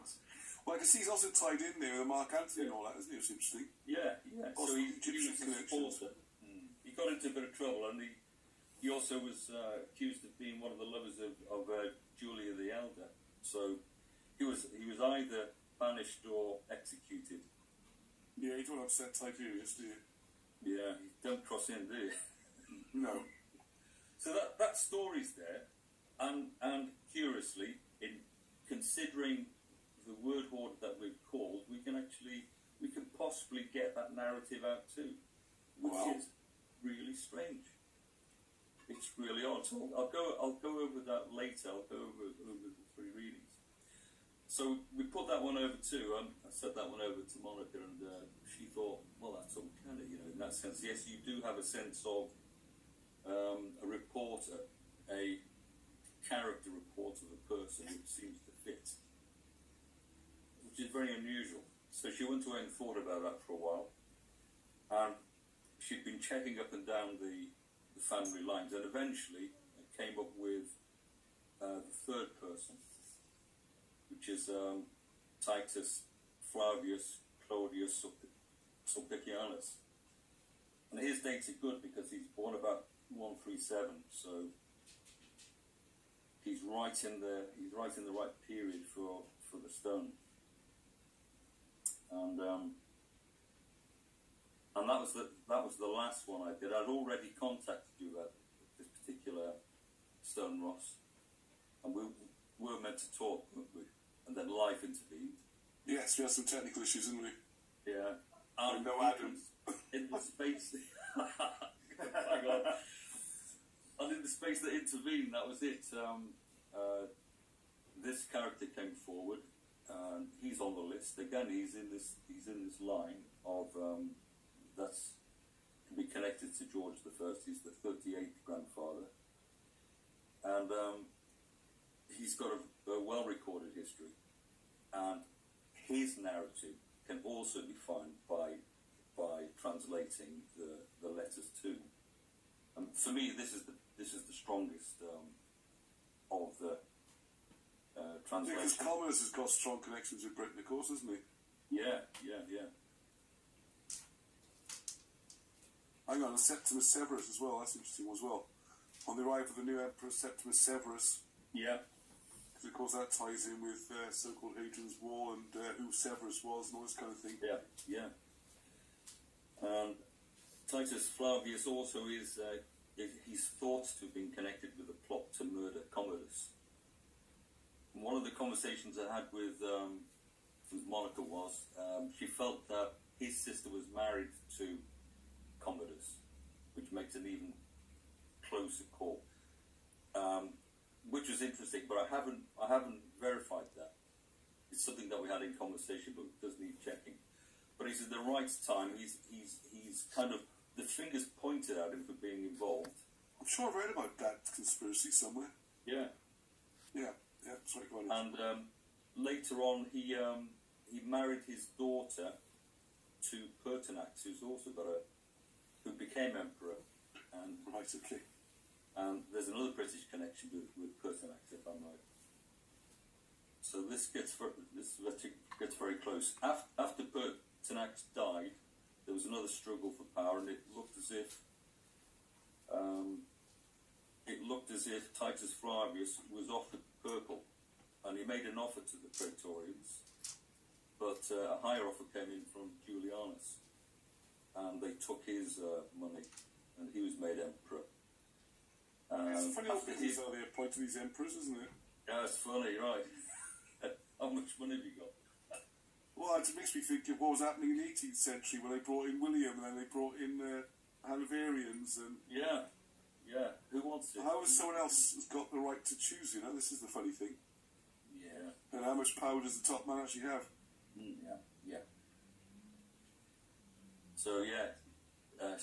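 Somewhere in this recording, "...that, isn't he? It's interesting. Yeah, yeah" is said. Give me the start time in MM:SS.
00:02.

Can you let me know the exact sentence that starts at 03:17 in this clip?
But he's at the right time.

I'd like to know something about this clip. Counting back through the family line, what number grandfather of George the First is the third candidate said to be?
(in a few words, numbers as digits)
38th.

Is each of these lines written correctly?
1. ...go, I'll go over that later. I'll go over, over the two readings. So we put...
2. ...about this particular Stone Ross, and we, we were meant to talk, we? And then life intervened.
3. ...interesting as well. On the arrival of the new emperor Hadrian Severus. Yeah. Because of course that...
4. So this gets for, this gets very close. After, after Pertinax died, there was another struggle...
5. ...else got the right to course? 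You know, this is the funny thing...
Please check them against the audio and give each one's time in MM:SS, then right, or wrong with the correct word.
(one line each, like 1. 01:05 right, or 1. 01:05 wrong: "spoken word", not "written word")
1. 00:40 wrong: "three", not "two"
2. 01:38 right
3. 02:37 wrong: "Septimus", not "Hadrian"
4. 03:43 right
5. 04:24 wrong: "choose", not "course".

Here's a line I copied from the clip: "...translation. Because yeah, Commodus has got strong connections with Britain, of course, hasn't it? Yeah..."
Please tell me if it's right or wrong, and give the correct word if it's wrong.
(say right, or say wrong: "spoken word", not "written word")
right.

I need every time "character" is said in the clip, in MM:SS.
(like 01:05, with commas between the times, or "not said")
00:56, 01:58.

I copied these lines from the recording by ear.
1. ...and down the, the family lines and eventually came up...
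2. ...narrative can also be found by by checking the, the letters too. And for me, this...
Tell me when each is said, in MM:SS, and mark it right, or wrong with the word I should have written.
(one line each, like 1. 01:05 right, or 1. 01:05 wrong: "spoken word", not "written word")
1. 01:06 right
2. 02:16 wrong: "translating", not "checking".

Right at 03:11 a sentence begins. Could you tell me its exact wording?
But I haven't I haven't verified that.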